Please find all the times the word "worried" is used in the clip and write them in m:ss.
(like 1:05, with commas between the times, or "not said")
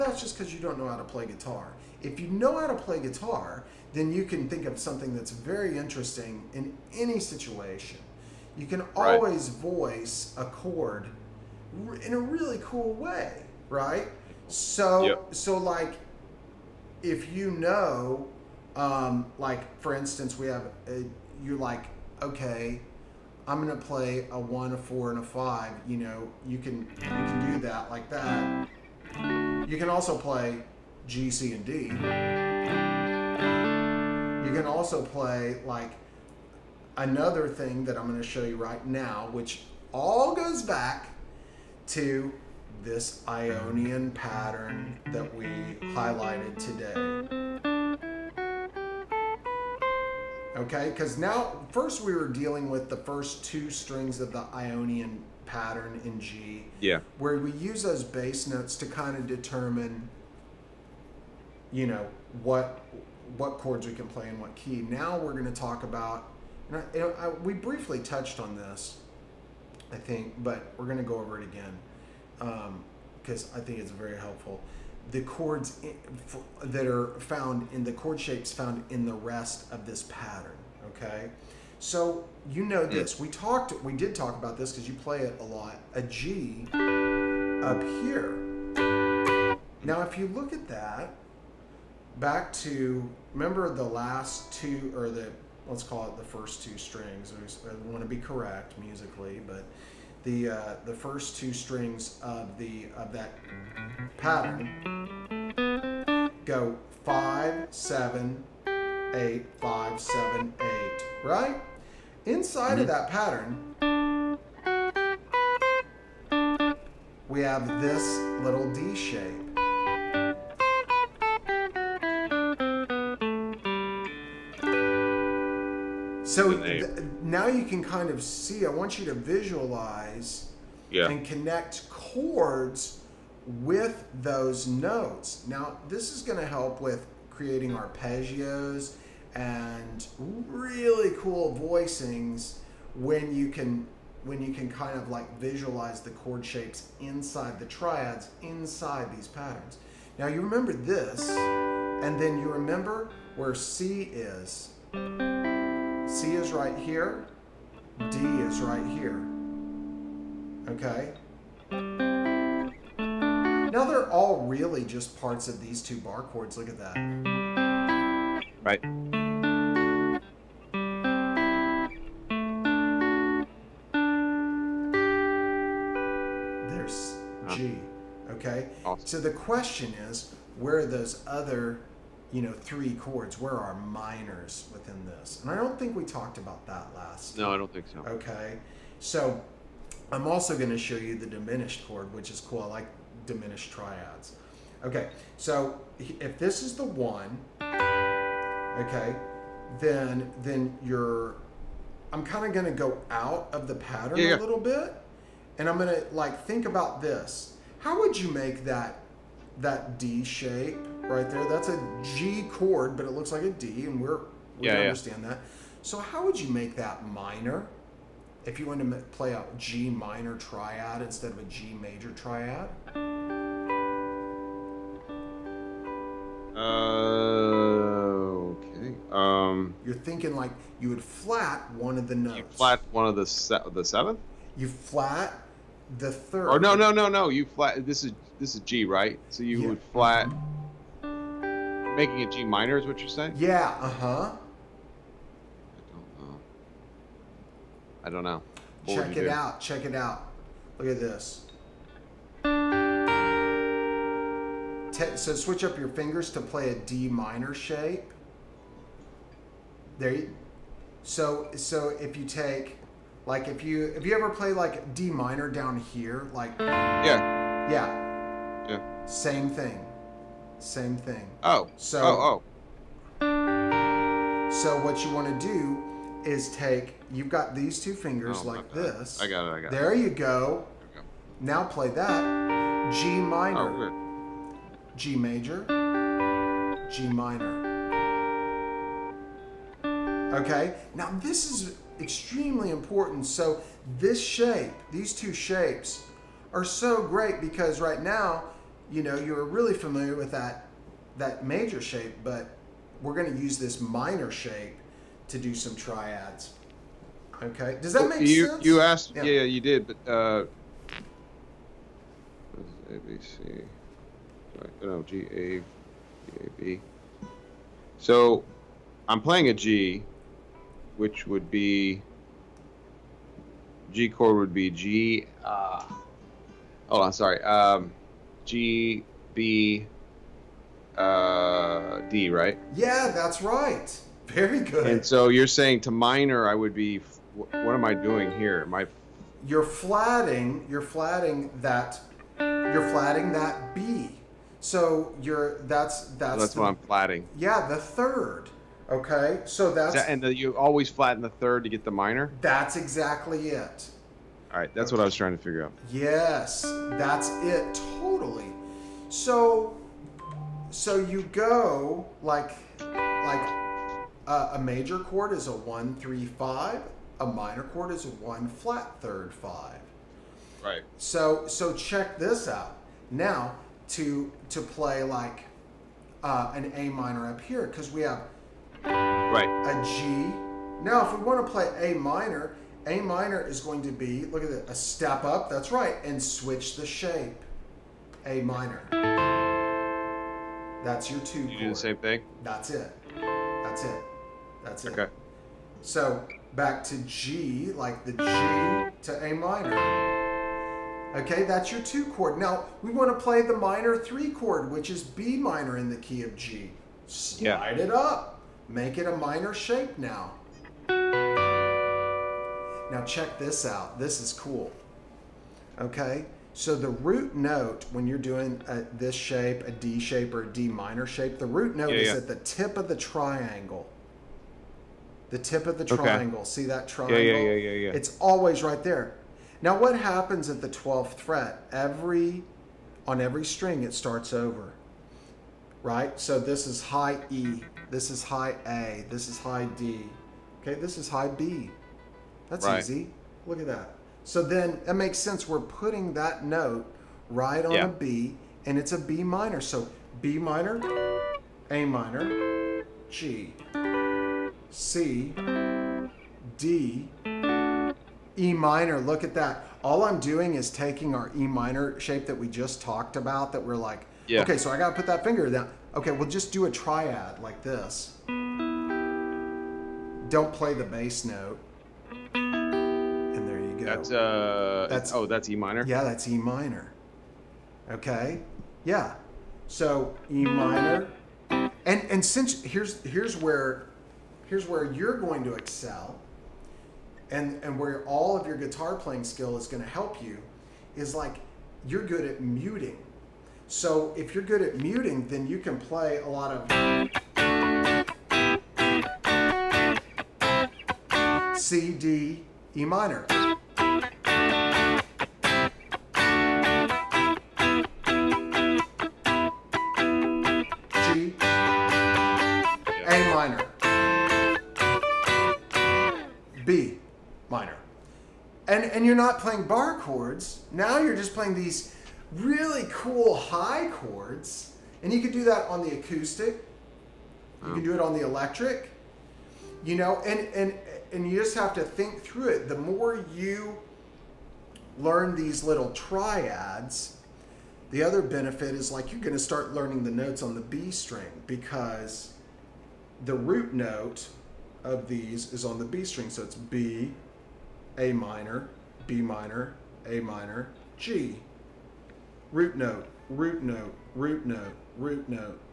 not said.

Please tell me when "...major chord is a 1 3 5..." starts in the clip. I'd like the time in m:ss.
6:04.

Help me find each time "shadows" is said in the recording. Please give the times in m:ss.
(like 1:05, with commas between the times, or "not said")
not said.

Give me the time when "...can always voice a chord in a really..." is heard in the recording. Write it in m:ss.
0:08.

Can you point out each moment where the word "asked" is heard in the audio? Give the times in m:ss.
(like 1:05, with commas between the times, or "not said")
5:08.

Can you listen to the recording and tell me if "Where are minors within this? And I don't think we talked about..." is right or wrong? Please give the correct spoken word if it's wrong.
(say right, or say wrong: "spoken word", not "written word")
right.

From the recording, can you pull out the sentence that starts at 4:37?
You've got these two fingers oh, like this.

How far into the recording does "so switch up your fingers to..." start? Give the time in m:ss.
4:15.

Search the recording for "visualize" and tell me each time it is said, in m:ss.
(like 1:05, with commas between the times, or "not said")
2:09, 2:25.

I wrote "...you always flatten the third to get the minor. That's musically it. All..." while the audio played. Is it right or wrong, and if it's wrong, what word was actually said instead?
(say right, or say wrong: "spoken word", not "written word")
wrong: "exactly", not "musically".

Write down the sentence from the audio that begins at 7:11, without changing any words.
Every, on every string, it starts over, right?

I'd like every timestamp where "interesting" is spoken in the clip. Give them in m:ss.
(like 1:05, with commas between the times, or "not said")
0:05.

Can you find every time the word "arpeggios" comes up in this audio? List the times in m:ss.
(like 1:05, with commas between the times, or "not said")
2:17.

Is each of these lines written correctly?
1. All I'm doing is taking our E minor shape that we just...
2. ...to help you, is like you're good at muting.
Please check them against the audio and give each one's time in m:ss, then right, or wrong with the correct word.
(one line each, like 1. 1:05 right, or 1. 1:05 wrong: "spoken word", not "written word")
1. 7:39 right
2. 8:09 right.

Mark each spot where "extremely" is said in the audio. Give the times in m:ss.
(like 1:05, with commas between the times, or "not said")
4:52.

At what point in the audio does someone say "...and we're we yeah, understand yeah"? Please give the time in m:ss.
3:33.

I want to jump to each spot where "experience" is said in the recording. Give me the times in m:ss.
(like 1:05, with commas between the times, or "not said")
not said.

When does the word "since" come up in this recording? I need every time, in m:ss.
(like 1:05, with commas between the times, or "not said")
8:02.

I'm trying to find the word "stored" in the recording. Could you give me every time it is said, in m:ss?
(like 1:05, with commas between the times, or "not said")
not said.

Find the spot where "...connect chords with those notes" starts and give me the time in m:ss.
2:11.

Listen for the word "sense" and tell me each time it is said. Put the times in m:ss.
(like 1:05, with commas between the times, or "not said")
5:08, 7:25.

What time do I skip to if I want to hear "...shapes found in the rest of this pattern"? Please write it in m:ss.
1:18.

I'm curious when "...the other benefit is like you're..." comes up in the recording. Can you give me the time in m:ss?
8:57.